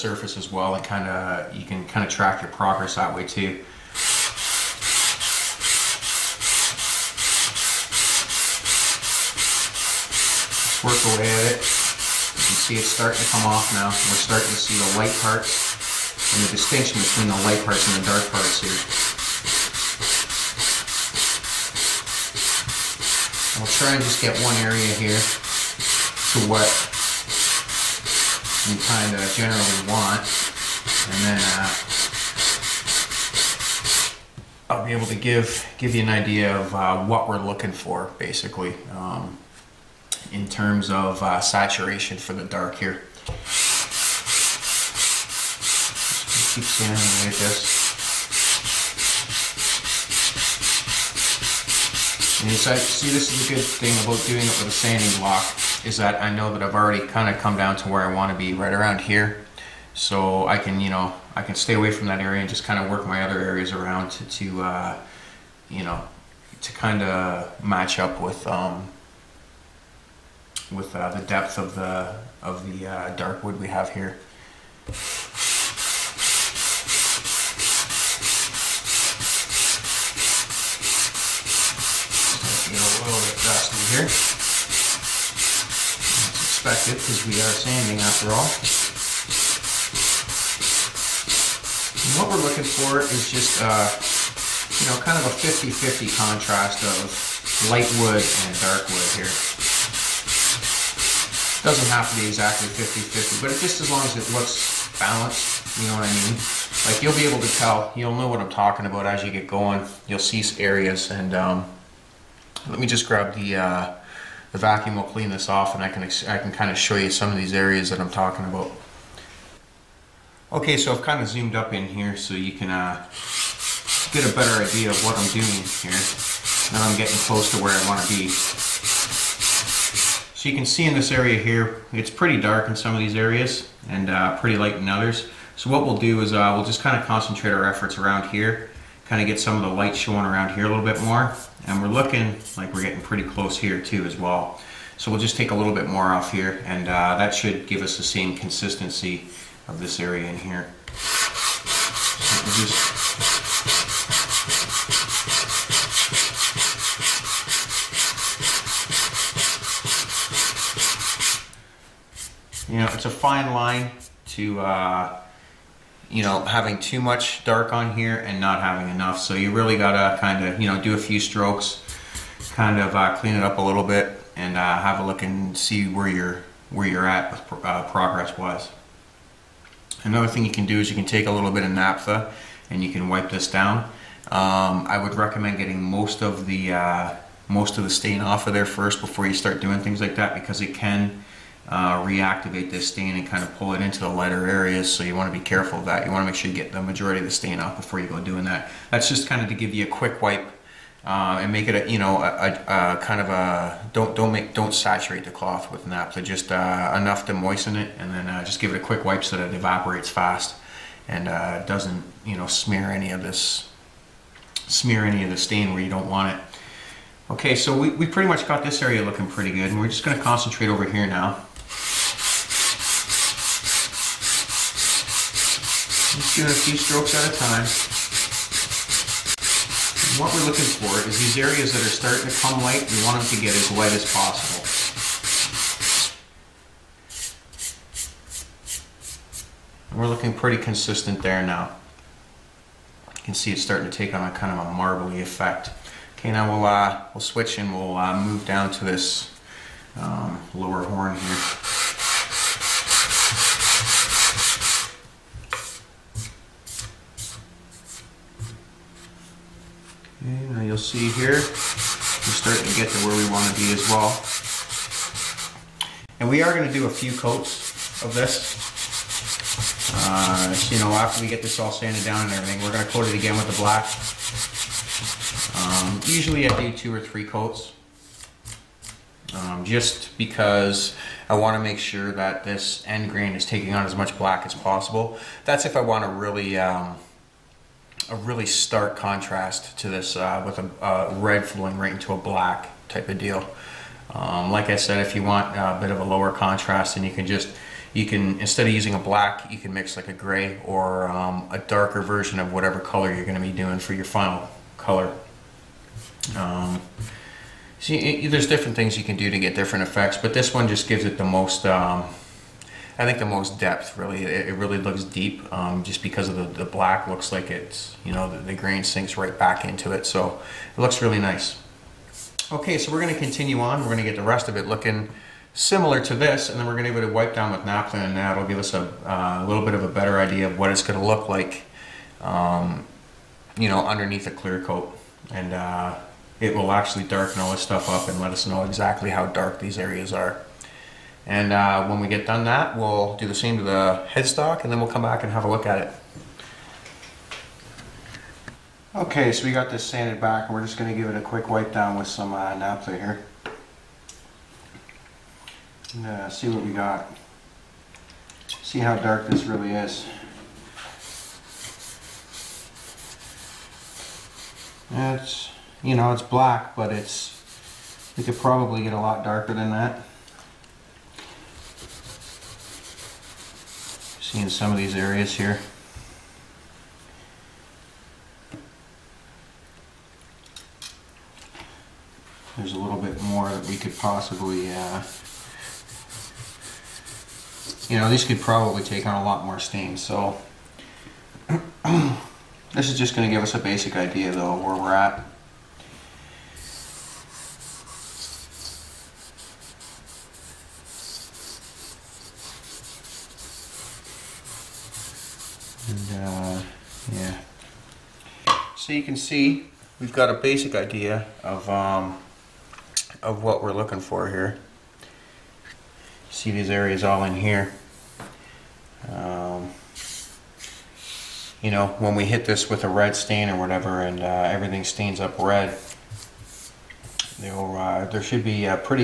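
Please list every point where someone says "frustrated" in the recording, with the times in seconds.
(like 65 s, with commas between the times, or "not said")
not said.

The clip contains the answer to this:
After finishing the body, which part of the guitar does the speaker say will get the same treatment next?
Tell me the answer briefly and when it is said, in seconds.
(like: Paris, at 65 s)
headstock, at 344 s.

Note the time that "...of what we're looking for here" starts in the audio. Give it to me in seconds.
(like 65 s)
413 s.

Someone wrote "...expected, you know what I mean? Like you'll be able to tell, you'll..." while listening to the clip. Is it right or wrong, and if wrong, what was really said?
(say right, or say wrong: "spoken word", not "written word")
wrong: "balanced", not "expected".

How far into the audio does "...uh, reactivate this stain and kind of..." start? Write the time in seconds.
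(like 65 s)
191 s.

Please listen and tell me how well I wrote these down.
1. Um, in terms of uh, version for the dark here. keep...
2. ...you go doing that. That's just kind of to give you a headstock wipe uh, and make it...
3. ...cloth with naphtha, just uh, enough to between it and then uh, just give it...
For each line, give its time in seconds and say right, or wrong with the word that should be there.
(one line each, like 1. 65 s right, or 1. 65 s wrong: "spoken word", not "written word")
1. 38 s wrong: "saturation", not "version"
2. 197 s wrong: "quick", not "headstock"
3. 205 s wrong: "moisten", not "between".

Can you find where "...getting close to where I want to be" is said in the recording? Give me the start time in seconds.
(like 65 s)
126 s.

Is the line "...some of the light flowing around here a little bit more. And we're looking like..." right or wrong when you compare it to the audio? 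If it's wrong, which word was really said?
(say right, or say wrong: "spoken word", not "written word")
wrong: "showing", not "flowing".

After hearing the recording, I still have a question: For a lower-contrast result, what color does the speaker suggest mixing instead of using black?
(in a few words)
gray.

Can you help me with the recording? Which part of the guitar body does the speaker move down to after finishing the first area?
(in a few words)
lower horn.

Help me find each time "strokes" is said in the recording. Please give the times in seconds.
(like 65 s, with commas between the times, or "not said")
171 s, 226 s.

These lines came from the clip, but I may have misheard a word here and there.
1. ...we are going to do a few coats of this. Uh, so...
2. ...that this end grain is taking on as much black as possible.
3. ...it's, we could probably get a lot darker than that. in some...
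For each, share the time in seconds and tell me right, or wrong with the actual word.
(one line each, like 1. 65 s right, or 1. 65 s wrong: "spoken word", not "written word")
1. 266 s right
2. 282 s right
3. 366 s right.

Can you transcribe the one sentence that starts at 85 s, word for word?
It's expected because we are sanding after all.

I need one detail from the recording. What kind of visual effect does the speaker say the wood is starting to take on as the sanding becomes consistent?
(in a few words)
marbly effect.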